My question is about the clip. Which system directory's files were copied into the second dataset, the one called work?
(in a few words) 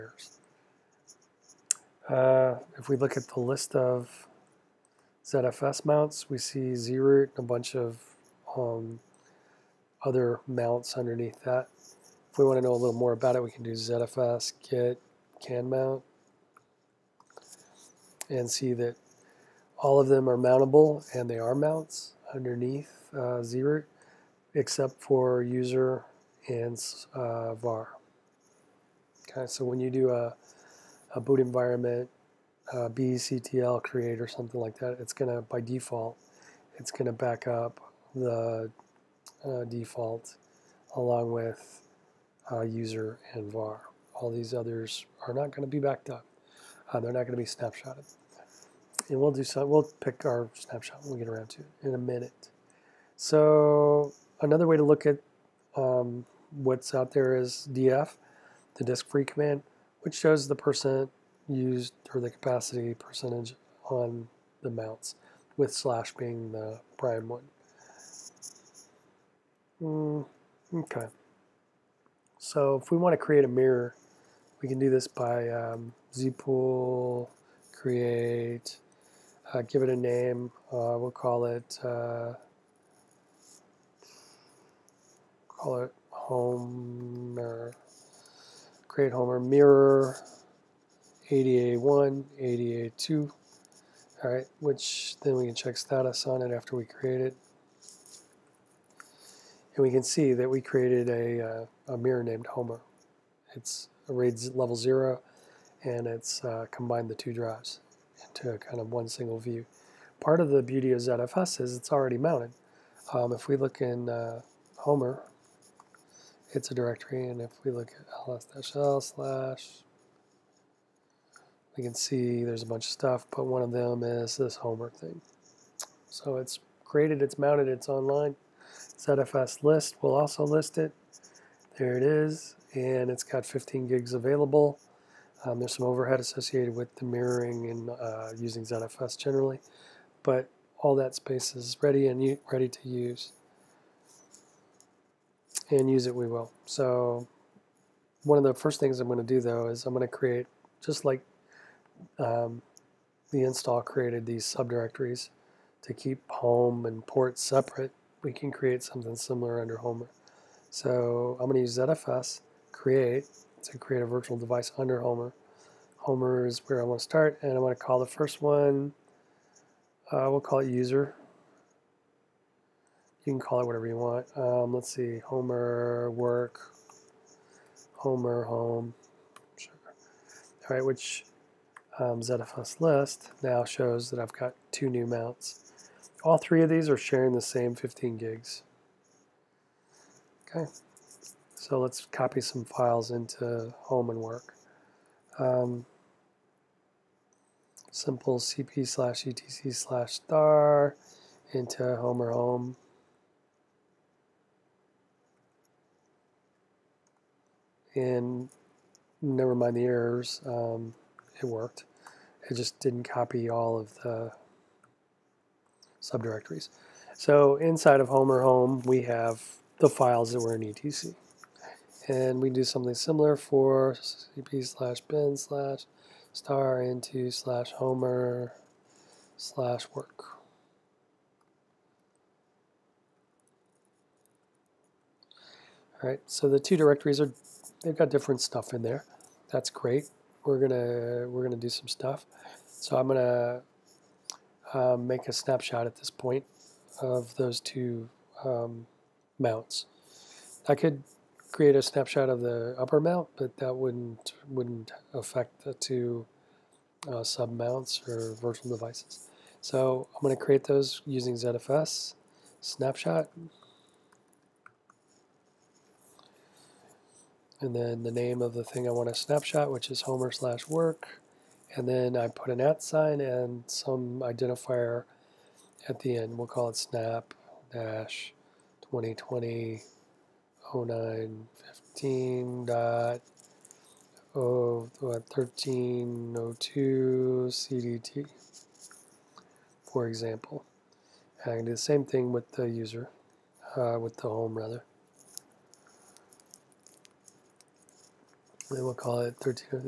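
/bin.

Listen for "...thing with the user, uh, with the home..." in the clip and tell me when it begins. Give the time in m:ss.
4:52.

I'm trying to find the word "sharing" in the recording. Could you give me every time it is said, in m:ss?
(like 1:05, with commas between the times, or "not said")
3:06.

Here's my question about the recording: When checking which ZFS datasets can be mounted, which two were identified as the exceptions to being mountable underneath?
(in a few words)
user and var.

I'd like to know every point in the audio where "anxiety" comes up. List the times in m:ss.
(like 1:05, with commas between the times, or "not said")
not said.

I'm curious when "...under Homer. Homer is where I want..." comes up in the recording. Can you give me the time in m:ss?
2:44.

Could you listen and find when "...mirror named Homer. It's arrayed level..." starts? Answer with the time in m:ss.
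1:41.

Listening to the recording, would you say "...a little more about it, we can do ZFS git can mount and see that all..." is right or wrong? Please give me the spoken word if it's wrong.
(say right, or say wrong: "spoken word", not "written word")
right.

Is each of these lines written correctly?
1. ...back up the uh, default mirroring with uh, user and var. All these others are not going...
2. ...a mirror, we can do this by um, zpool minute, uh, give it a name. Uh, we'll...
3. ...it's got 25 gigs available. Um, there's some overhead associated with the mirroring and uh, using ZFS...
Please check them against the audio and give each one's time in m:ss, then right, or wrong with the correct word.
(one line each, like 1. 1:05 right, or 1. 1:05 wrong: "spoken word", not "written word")
1. 0:37 wrong: "along", not "mirroring"
2. 1:13 wrong: "create", not "minute"
3. 2:13 wrong: "15", not "25".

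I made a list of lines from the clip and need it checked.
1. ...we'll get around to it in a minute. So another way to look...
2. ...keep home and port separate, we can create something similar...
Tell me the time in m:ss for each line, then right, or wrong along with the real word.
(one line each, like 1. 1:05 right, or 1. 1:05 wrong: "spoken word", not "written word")
1. 0:51 right
2. 2:35 right.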